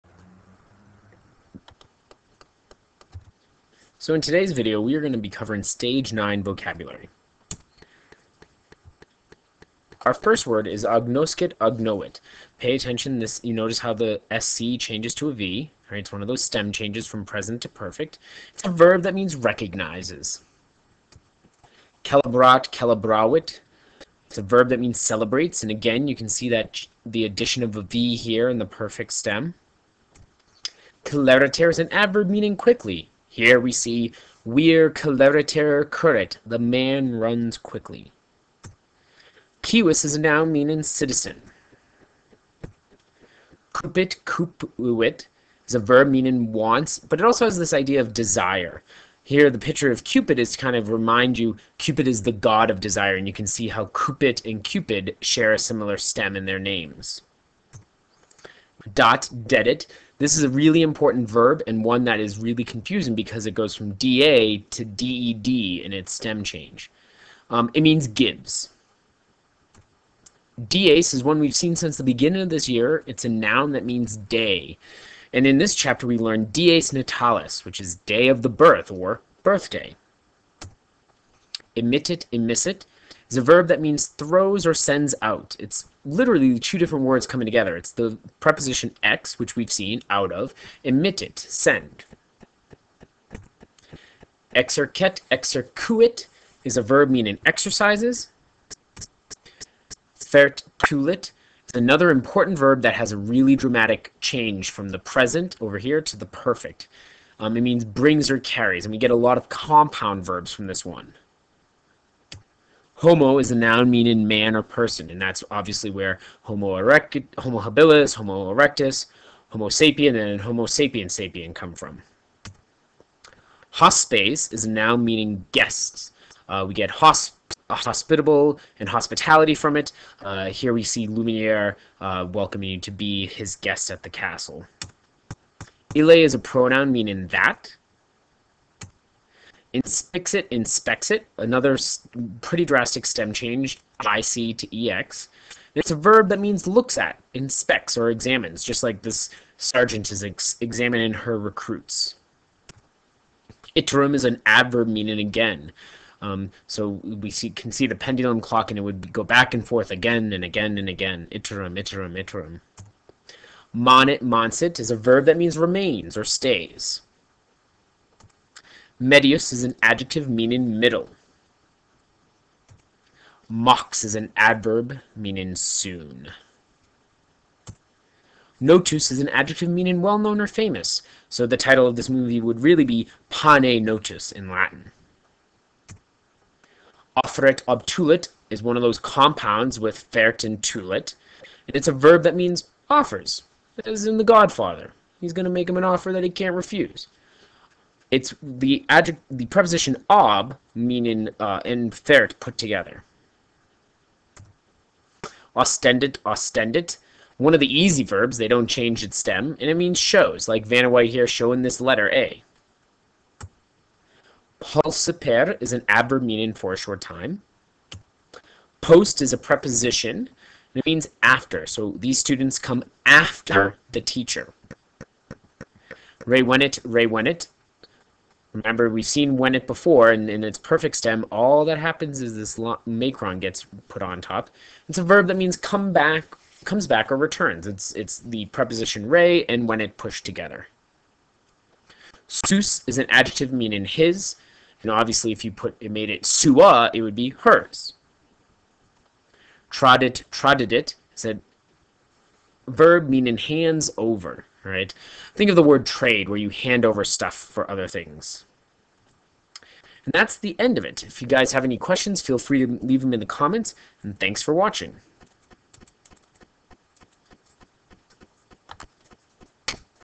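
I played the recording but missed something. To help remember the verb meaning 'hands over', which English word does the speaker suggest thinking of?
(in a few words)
trade.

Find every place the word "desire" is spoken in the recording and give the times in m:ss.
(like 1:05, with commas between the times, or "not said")
0:48, 0:52.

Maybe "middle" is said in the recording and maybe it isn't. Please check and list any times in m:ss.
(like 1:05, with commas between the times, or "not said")
2:50.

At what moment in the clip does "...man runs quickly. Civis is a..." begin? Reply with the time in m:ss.
0:36.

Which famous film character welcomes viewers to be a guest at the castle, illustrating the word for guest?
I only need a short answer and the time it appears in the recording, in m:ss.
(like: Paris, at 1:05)
Lumiere, at 2:11.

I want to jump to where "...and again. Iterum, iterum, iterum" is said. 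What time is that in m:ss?
2:40.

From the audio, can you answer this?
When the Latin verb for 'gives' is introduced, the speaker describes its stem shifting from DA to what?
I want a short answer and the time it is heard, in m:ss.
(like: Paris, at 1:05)
DED, at 1:04.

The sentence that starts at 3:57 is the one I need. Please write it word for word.
It's it's the preposition re and when it pushed together.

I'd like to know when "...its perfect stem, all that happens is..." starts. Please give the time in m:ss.
3:50.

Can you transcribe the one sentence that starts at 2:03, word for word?
Hospes is a noun meaning guests.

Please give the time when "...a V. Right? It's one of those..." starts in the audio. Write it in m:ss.
0:15.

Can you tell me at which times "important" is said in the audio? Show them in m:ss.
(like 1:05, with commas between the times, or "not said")
1:00, 1:42.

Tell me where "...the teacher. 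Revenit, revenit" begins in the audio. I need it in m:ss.
3:43.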